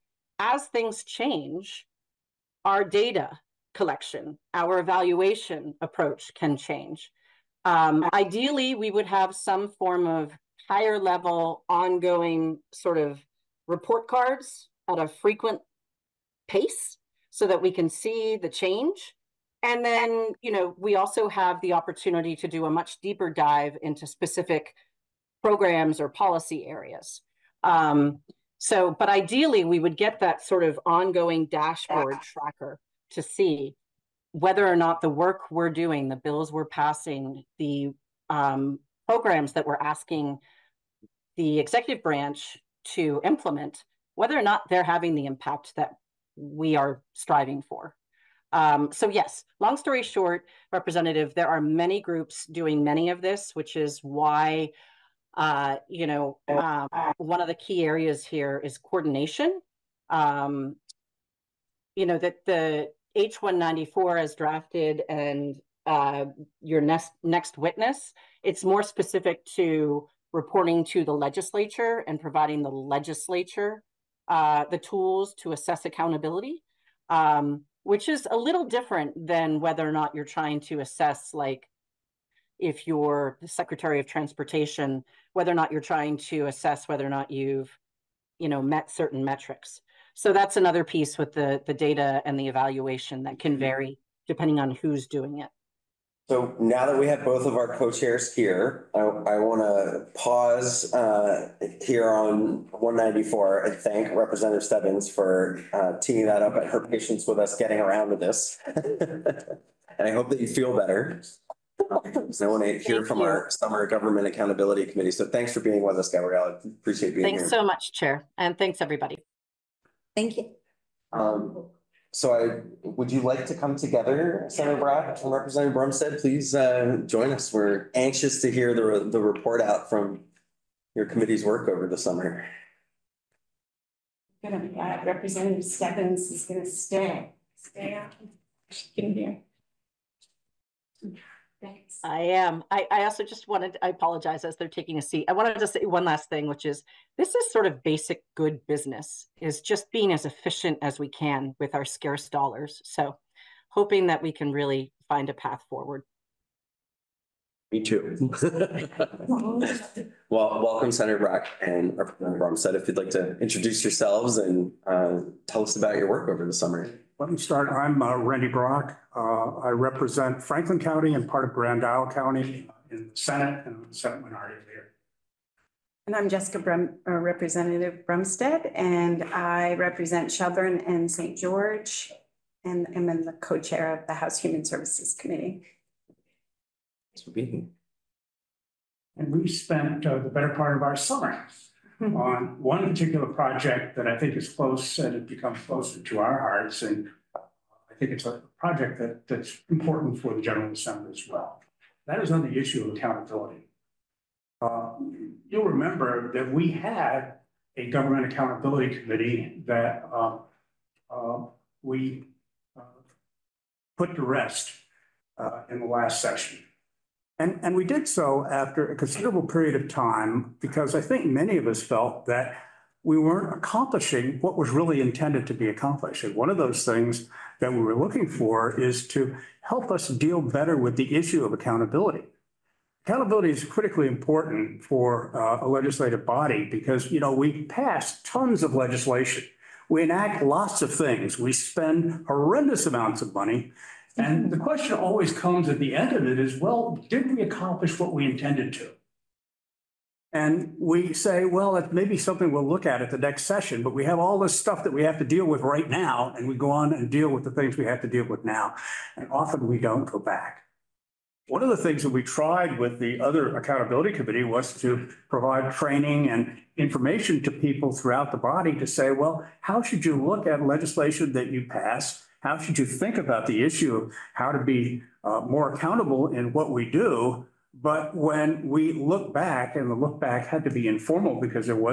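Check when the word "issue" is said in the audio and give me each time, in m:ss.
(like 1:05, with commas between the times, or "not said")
3:22, 3:51, 4:33.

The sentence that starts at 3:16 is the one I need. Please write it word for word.
And I think it's a project that, that's important for the General Assembly as well.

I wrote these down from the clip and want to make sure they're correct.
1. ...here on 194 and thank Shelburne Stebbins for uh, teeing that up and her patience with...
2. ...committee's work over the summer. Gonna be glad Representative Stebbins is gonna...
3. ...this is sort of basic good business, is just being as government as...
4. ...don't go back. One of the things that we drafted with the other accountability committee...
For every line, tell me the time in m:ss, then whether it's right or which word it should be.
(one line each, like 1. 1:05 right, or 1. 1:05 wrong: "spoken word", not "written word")
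1. 1:41 wrong: "Representative", not "Shelburne"
2. 2:11 right
3. 2:27 wrong: "efficient", not "government"
4. 4:19 wrong: "tried", not "drafted".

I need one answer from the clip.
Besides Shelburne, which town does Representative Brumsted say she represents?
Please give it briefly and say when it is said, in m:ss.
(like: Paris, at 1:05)
St. George, at 3:01.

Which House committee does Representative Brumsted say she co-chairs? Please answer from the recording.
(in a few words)
House Human Services Committee.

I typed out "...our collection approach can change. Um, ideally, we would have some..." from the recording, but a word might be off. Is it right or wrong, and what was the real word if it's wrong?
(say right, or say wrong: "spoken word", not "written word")
wrong: "evaluation", not "collection".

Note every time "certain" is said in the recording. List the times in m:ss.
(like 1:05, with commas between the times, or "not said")
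1:28.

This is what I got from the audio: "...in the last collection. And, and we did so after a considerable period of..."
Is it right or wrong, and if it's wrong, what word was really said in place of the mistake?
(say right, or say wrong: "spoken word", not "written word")
wrong: "session", not "collection".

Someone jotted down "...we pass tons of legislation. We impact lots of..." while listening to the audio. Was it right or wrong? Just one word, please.
wrong.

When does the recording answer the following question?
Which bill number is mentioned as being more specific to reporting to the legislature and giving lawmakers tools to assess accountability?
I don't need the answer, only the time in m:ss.
1:03.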